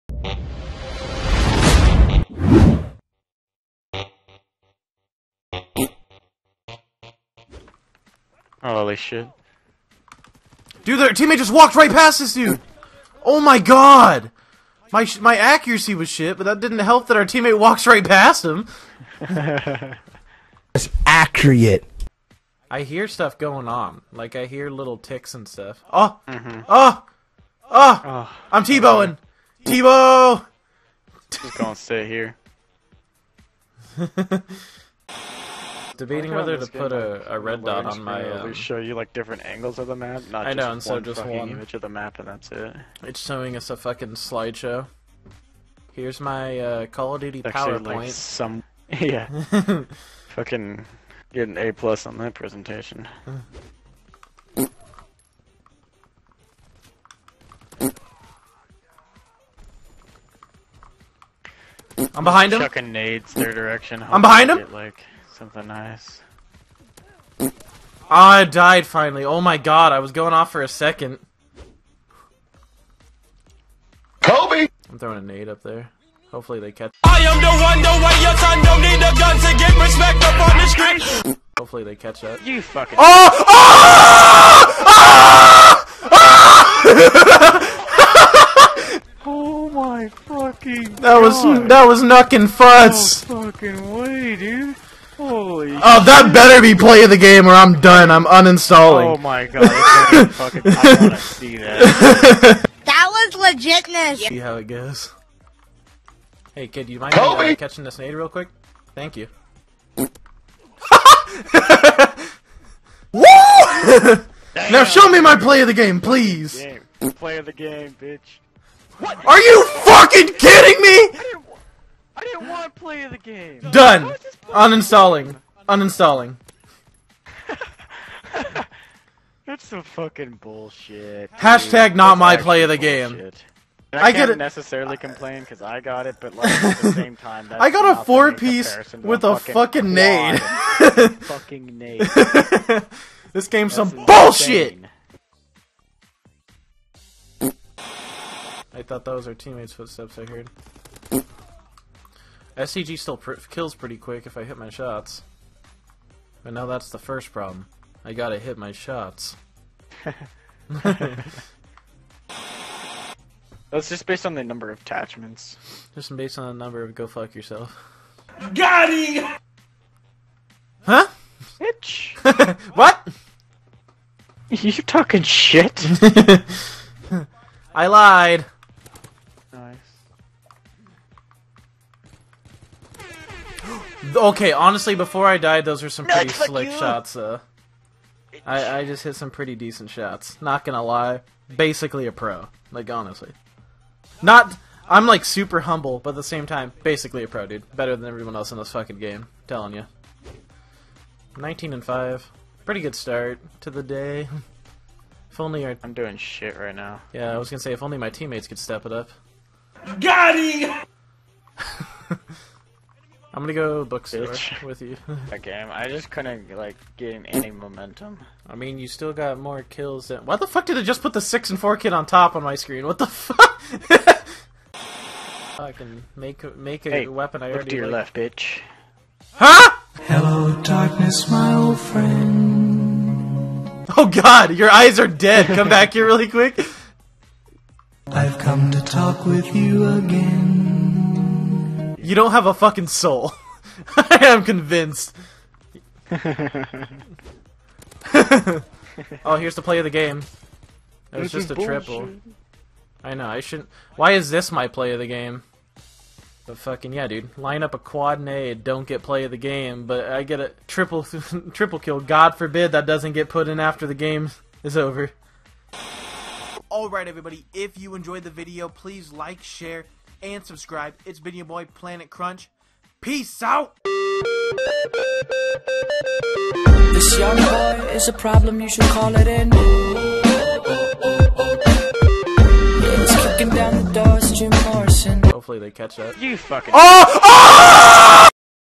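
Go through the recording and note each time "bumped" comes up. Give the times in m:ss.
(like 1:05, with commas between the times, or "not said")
not said.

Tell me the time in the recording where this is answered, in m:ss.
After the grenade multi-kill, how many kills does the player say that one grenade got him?
2:18.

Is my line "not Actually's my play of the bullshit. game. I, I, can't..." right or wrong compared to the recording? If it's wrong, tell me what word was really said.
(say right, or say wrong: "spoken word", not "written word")
wrong: "That", not "Actually".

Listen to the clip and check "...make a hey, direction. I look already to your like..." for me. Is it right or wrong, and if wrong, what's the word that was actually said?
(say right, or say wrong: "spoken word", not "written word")
wrong: "weapon", not "direction".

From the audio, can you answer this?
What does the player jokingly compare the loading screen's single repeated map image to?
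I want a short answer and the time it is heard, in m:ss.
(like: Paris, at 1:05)
PowerPoint, at 0:47.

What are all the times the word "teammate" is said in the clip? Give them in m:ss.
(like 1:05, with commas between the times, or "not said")
0:11, 0:17, 2:29, 3:28.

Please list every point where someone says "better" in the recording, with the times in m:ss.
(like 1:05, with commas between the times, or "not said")
1:36, 3:17.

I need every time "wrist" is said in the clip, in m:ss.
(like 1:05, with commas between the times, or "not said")
not said.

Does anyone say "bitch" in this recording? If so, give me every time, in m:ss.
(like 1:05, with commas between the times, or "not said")
1:58, 2:51, 3:34, 3:48.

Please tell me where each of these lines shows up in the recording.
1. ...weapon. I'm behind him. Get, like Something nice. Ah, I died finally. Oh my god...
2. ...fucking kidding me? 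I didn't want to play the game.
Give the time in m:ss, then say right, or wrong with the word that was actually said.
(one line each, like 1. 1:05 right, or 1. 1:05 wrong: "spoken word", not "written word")
1. 1:03 wrong: "direction", not "weapon"
2. 1:59 right.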